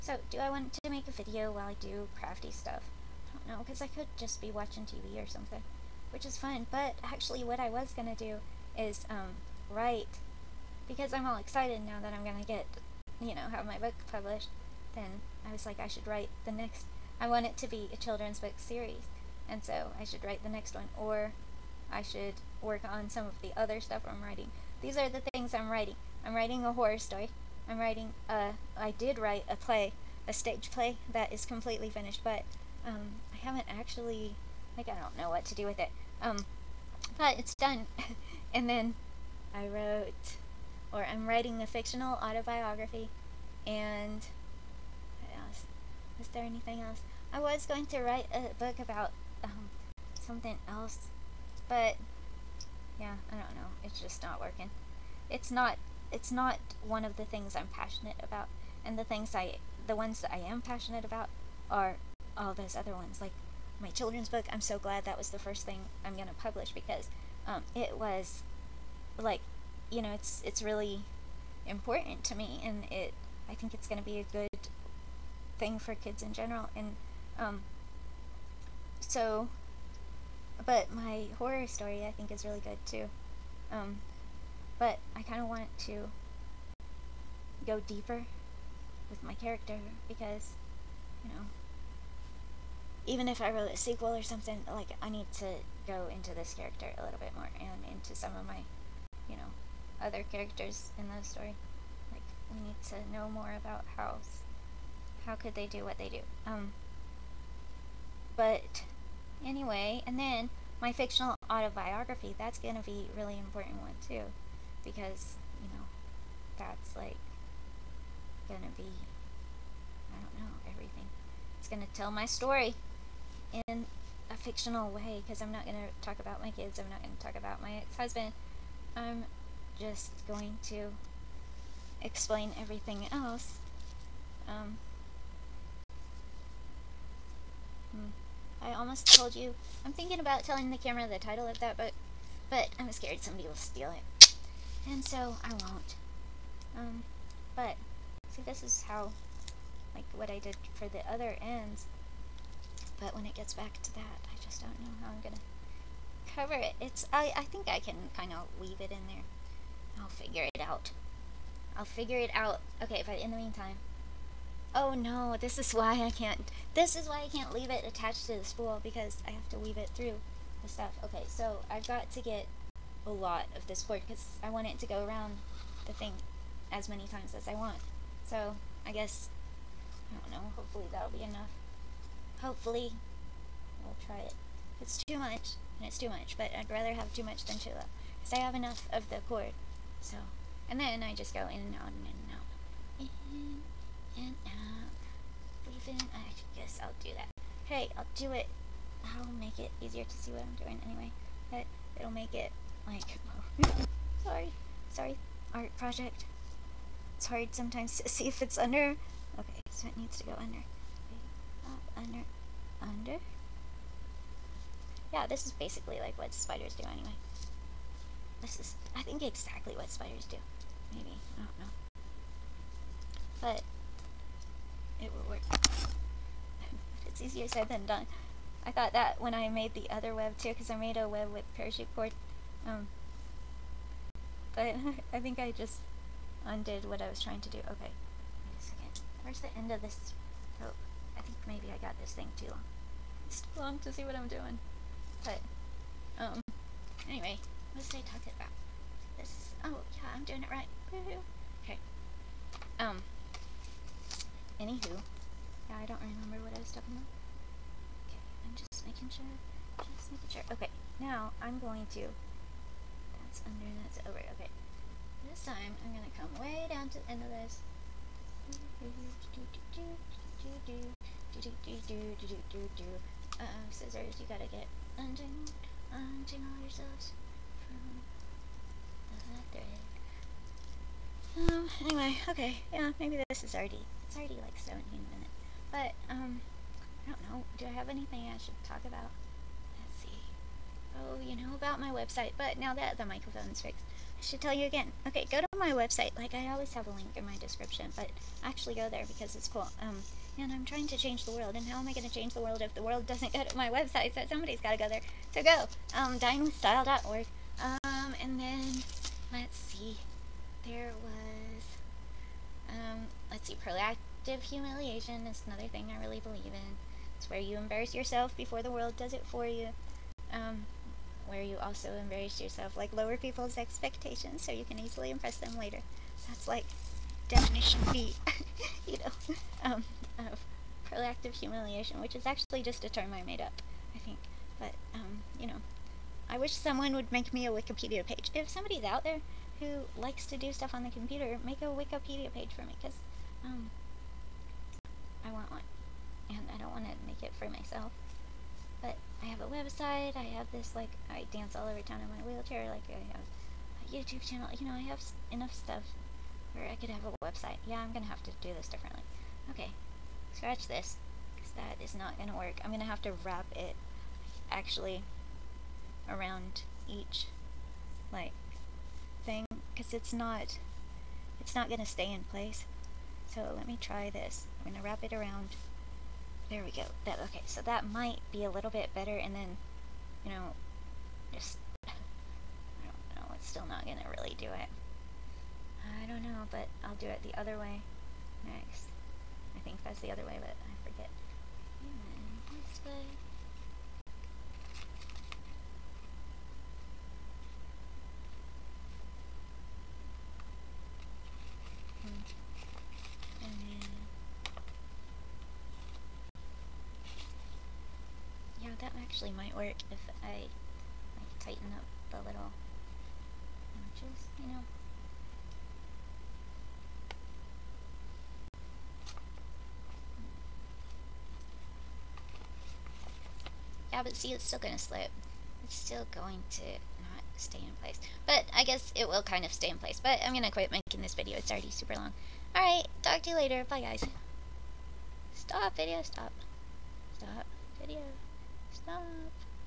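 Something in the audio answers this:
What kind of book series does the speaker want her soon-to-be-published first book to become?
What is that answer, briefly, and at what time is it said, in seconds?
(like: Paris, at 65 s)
children's book series, at 17 s.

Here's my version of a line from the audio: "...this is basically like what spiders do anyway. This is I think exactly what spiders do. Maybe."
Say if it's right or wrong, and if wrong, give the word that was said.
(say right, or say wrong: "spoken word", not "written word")
right.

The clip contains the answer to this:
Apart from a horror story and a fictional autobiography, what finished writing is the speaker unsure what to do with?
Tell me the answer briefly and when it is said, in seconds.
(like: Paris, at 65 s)
stage play, at 30 s.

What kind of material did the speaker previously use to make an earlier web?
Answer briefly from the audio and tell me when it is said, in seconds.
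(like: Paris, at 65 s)
parachute cord, at 231 s.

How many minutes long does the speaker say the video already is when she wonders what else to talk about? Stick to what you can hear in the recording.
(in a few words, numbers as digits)
17.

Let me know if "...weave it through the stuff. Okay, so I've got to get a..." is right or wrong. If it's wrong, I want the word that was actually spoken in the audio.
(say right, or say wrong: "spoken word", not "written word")
right.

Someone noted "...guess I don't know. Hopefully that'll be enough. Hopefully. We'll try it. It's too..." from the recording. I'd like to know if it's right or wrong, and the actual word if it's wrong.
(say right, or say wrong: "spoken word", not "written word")
right.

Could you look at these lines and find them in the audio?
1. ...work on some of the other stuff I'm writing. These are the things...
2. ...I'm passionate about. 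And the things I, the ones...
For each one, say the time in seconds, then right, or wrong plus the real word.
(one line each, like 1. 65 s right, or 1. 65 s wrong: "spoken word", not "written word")
1. 22 s right
2. 57 s right.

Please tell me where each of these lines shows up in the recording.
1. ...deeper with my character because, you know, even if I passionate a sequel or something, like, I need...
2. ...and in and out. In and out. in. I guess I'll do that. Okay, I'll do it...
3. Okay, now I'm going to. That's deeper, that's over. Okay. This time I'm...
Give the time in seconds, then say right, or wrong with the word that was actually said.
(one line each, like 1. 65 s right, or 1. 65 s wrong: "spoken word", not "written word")
1. 87 s wrong: "wrote", not "passionate"
2. 191 s right
3. 260 s wrong: "under", not "deeper".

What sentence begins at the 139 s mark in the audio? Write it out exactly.
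I'm thinking about telling the camera the title of that book, but I'm scared somebody will steal it.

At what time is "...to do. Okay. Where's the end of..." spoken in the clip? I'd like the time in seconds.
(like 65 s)
237 s.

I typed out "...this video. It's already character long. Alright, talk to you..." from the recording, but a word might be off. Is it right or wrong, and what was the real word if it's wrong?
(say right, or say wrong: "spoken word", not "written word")
wrong: "super", not "character".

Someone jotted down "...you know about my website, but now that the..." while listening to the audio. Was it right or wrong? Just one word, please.
right.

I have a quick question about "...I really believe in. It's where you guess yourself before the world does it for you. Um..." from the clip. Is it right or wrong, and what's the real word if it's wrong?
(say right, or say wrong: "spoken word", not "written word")
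wrong: "embarrass", not "guess".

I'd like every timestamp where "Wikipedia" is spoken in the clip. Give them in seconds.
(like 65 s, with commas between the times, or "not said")
337 s, 341 s.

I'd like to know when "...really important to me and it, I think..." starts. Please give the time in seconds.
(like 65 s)
70 s.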